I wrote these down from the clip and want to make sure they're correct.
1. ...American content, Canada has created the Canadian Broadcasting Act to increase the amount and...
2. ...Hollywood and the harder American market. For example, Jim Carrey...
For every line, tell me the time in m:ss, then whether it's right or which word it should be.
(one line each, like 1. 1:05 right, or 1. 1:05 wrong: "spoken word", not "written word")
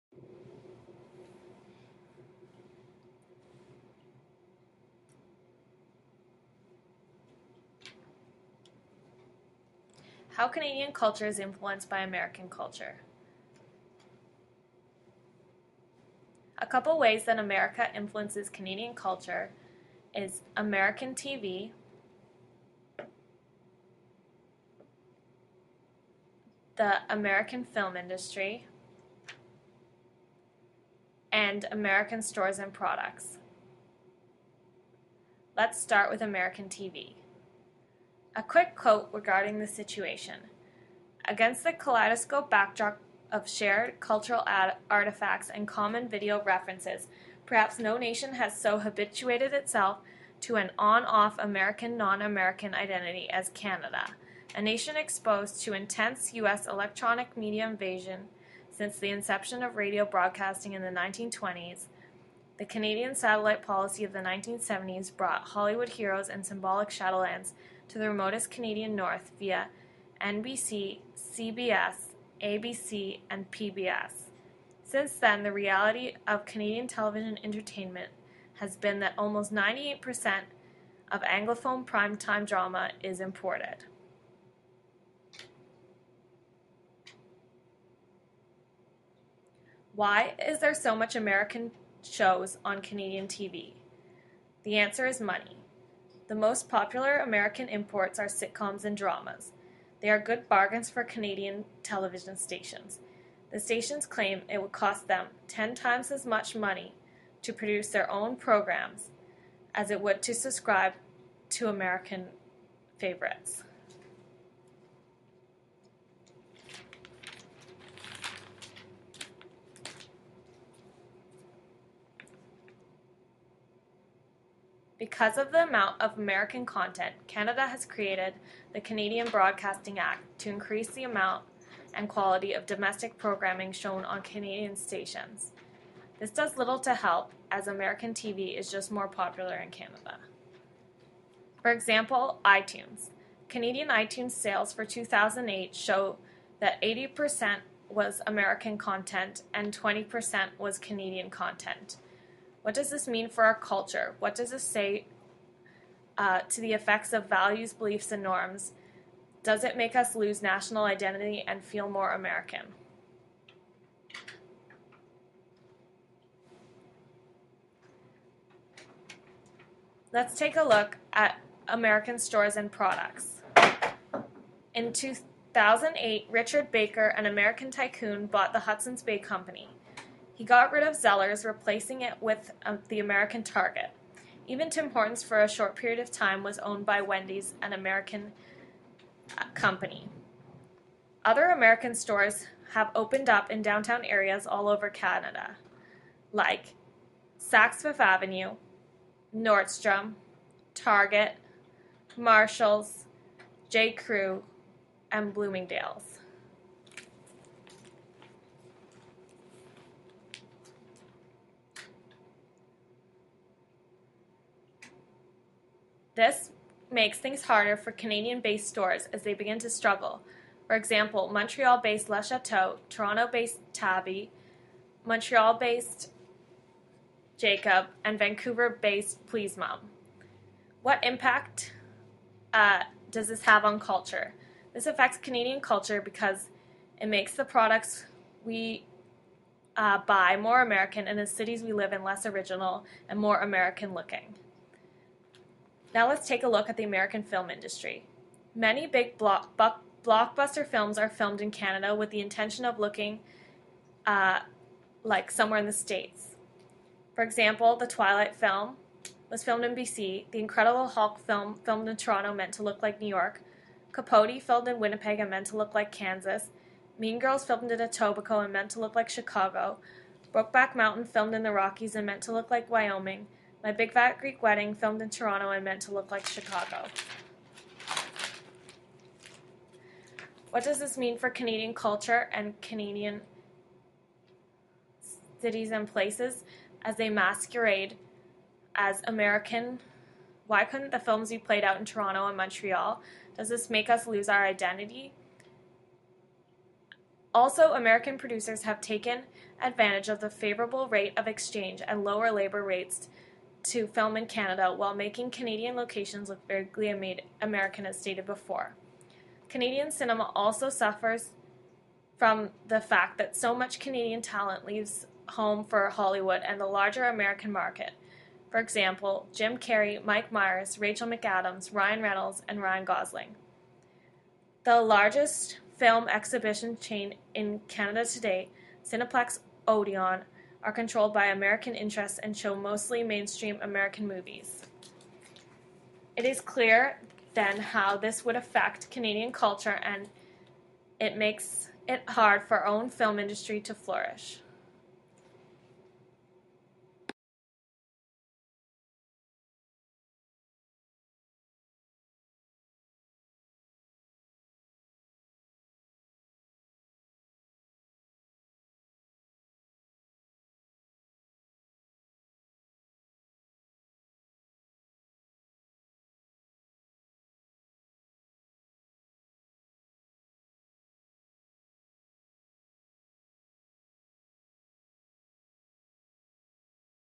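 1. 2:06 right
2. 5:15 wrong: "larger", not "harder".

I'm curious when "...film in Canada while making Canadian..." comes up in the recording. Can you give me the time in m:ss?
5:03.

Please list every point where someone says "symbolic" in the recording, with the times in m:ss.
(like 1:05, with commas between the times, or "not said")
1:06.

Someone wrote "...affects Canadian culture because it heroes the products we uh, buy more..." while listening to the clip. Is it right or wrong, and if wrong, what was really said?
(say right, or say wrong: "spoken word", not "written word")
wrong: "makes", not "heroes".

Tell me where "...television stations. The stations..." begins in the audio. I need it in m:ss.
1:41.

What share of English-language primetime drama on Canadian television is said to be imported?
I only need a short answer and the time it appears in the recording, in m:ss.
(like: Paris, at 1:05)
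98%, at 1:19.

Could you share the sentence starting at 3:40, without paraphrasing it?
For example, Montreal based Le Chateau, Toronto based Tabi, Montreal based Jacob, and Vancouver based Please Mom.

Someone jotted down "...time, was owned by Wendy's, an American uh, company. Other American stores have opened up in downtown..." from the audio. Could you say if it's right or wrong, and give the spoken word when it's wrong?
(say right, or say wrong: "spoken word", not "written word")
right.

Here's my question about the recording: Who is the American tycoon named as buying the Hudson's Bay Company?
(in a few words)
Richard Baker.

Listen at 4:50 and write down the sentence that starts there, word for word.
Why couldn't the films be played out in Toronto and Montreal?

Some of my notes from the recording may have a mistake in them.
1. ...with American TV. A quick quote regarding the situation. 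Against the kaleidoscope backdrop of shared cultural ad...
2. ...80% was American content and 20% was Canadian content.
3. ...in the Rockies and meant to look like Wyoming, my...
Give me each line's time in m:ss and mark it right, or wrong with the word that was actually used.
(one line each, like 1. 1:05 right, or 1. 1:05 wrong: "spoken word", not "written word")
1. 0:36 right
2. 2:26 right
3. 4:31 right.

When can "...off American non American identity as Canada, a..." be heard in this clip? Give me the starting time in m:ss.
0:51.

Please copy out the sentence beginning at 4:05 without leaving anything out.
Now let's take a look at the American film industry.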